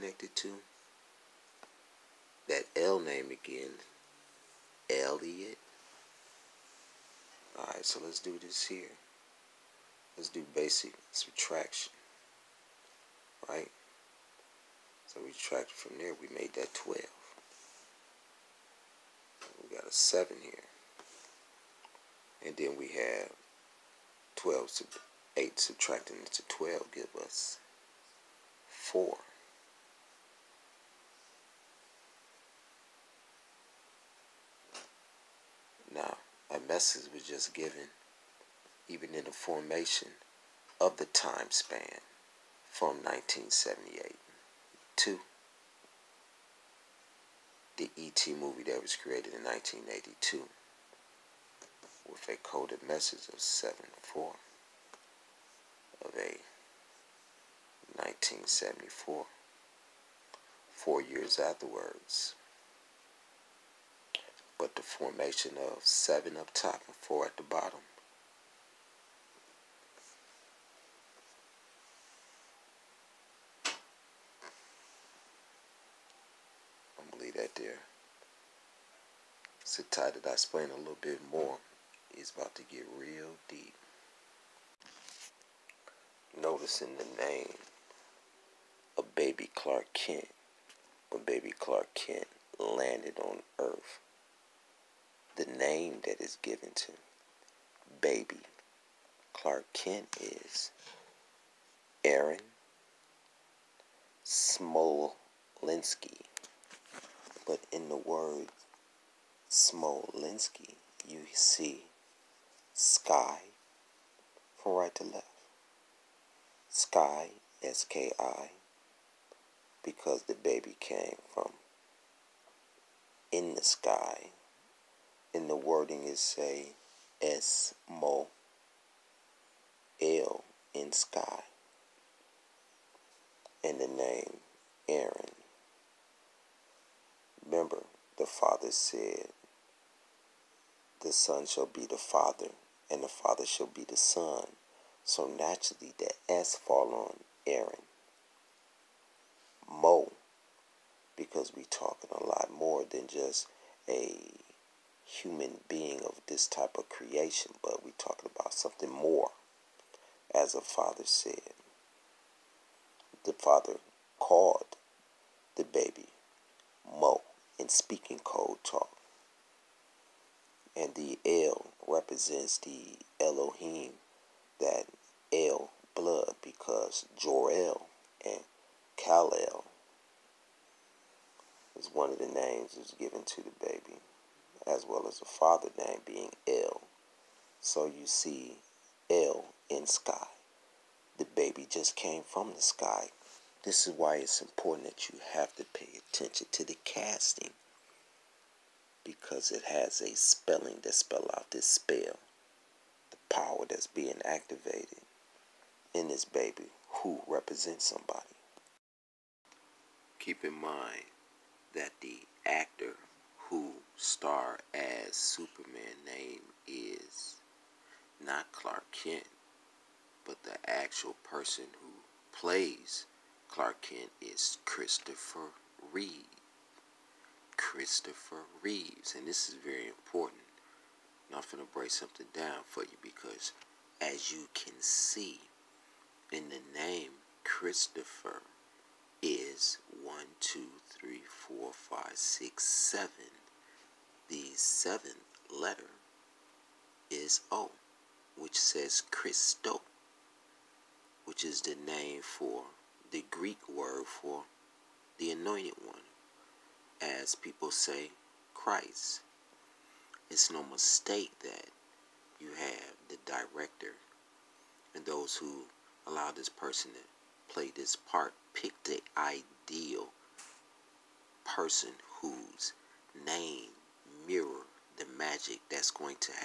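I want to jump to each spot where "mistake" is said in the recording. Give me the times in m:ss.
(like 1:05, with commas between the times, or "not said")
4:20.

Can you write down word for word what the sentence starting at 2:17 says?
Remember, the Father said, The Son shall be the Father, and the Father shall be the Son.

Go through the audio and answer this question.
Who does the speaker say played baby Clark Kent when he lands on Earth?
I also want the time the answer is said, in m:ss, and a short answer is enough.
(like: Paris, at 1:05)
Aaron Smolinski, at 1:42.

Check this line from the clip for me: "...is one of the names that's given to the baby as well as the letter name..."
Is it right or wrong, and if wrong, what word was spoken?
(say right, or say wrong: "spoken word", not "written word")
wrong: "father", not "letter".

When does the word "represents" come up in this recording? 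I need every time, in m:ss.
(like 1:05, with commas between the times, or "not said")
2:51, 3:27.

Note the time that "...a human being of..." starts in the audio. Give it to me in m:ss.
2:33.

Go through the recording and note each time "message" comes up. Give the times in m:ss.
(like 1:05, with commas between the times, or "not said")
0:36, 0:52.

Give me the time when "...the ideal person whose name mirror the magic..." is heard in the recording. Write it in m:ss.
4:28.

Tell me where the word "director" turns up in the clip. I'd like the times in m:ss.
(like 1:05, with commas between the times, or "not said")
4:23.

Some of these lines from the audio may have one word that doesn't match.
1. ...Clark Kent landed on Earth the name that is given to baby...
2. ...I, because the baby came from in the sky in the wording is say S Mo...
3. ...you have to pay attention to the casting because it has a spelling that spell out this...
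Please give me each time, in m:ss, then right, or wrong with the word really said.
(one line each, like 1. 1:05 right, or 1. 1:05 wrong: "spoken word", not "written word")
1. 1:31 right
2. 1:58 right
3. 3:15 right.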